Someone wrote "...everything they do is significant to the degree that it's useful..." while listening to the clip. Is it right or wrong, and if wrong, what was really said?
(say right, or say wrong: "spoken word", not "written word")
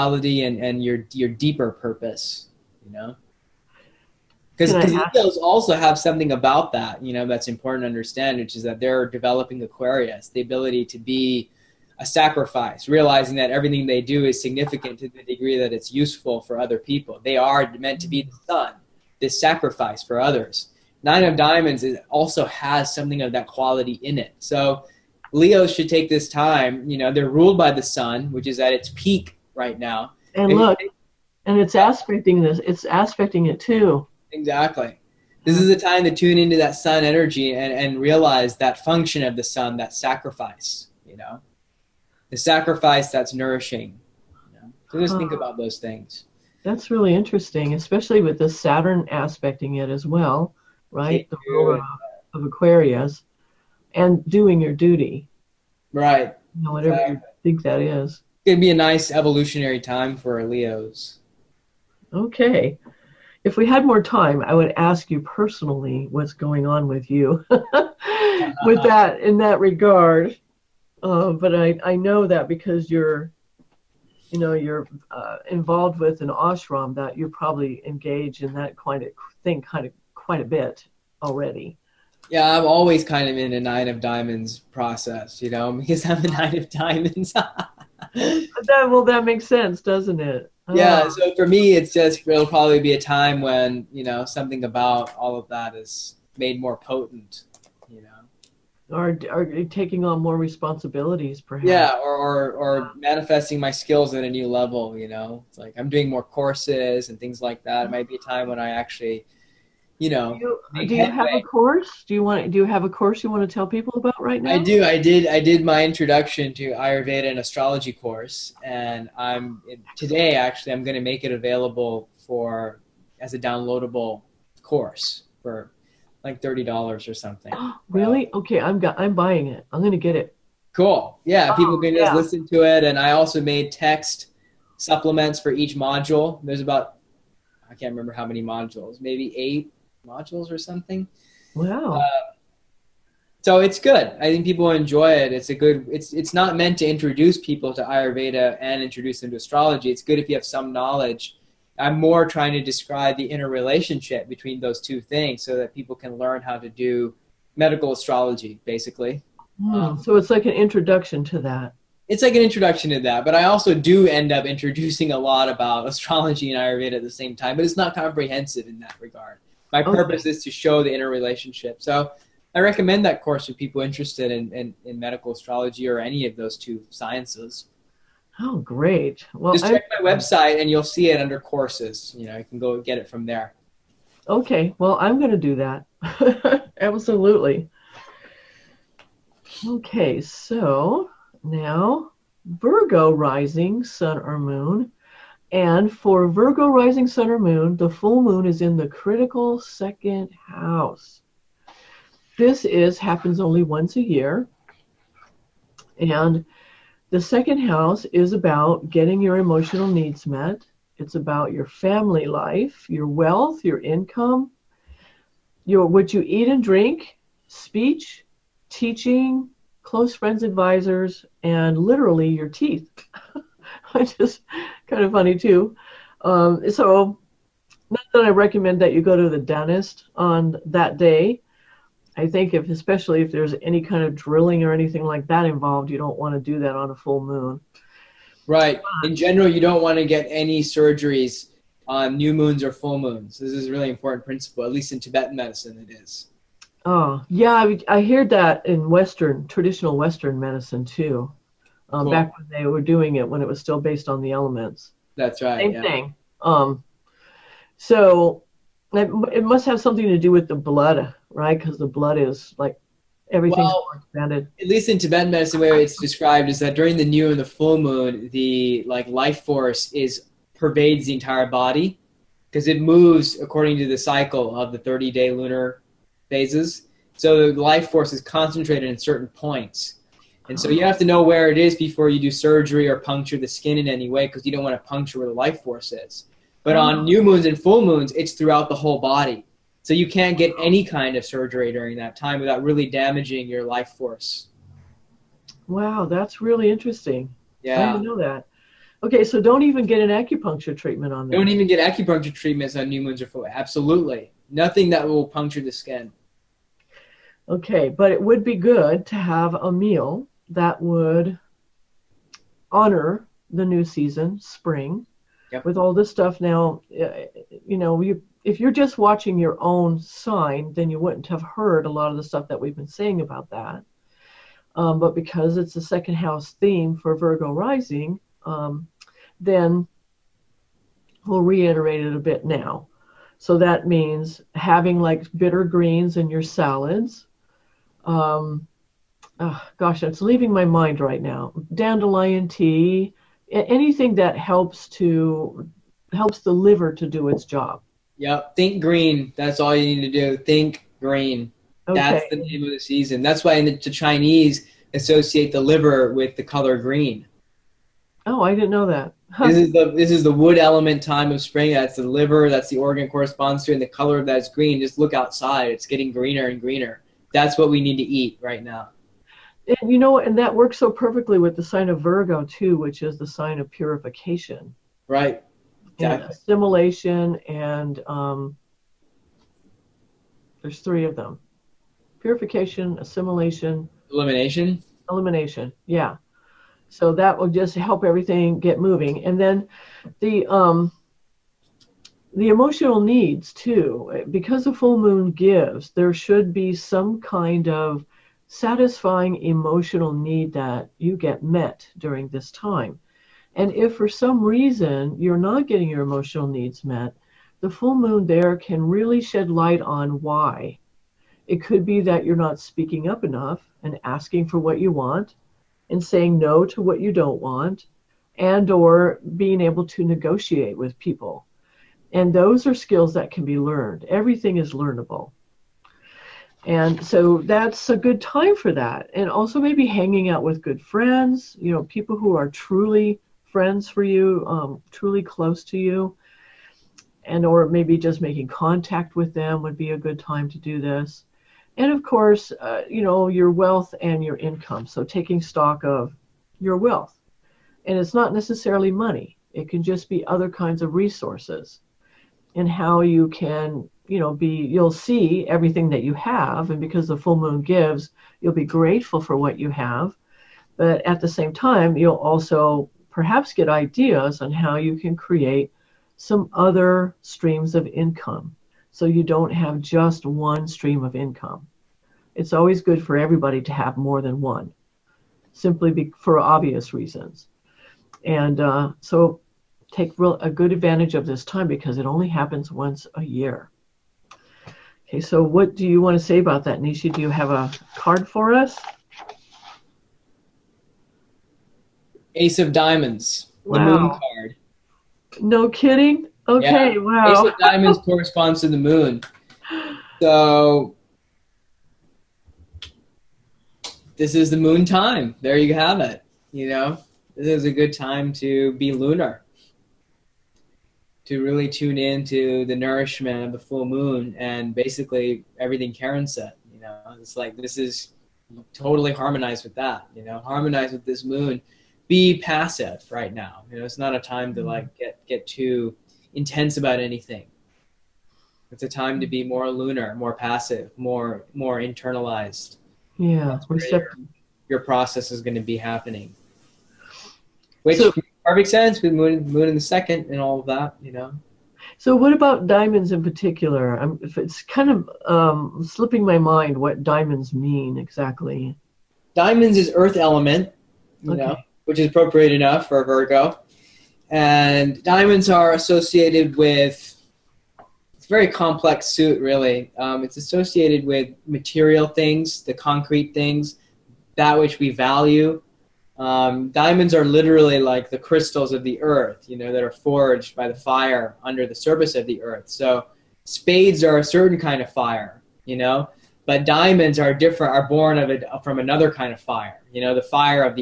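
right.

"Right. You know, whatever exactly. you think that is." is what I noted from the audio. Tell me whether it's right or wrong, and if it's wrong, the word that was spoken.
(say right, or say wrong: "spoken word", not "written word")
right.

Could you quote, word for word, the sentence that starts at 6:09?
And you know, and that works so perfectly with the sign of Virgo too, which is the sign of purification.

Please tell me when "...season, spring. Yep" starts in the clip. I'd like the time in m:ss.
5:13.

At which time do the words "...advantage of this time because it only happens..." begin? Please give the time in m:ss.
8:00.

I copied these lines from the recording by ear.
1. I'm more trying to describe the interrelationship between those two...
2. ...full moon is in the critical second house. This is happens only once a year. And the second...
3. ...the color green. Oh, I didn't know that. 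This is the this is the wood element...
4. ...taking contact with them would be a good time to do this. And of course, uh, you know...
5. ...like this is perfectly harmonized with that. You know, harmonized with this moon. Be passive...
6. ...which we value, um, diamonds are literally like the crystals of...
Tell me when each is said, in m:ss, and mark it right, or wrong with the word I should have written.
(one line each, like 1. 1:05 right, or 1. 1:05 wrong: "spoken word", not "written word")
1. 2:31 right
2. 3:17 right
3. 5:56 right
4. 7:18 wrong: "making", not "taking"
5. 8:37 wrong: "totally", not "perfectly"
6. 9:24 right.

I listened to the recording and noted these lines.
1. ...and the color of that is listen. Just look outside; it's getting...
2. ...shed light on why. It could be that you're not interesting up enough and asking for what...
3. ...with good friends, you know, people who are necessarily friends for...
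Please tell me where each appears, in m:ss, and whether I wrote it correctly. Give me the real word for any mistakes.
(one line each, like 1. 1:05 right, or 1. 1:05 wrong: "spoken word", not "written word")
1. 6:03 wrong: "green", not "listen"
2. 6:49 wrong: "speaking", not "interesting"
3. 7:10 wrong: "truly", not "necessarily".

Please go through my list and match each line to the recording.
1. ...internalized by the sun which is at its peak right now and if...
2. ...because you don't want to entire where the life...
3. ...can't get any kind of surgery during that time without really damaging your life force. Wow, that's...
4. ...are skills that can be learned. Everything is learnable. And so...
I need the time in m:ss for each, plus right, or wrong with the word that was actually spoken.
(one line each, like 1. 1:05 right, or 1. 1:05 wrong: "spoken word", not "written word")
1. 0:27 wrong: "ruled", not "internalized"
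2. 4:44 wrong: "puncture", not "entire"
3. 4:50 right
4. 7:02 right.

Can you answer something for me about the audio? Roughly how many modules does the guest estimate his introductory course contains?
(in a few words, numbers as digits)
8.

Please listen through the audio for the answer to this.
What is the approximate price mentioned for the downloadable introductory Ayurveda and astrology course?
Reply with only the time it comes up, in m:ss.
2:06.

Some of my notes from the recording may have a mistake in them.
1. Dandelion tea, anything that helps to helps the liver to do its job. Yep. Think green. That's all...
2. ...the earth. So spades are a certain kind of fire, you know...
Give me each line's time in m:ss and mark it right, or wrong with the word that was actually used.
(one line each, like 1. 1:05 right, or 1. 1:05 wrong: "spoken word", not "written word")
1. 5:41 right
2. 9:32 right.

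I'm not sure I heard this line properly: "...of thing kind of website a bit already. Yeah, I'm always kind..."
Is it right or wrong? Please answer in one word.
wrong.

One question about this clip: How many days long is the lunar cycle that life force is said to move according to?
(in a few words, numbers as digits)
30.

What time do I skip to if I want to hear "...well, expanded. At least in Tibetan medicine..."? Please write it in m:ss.
4:23.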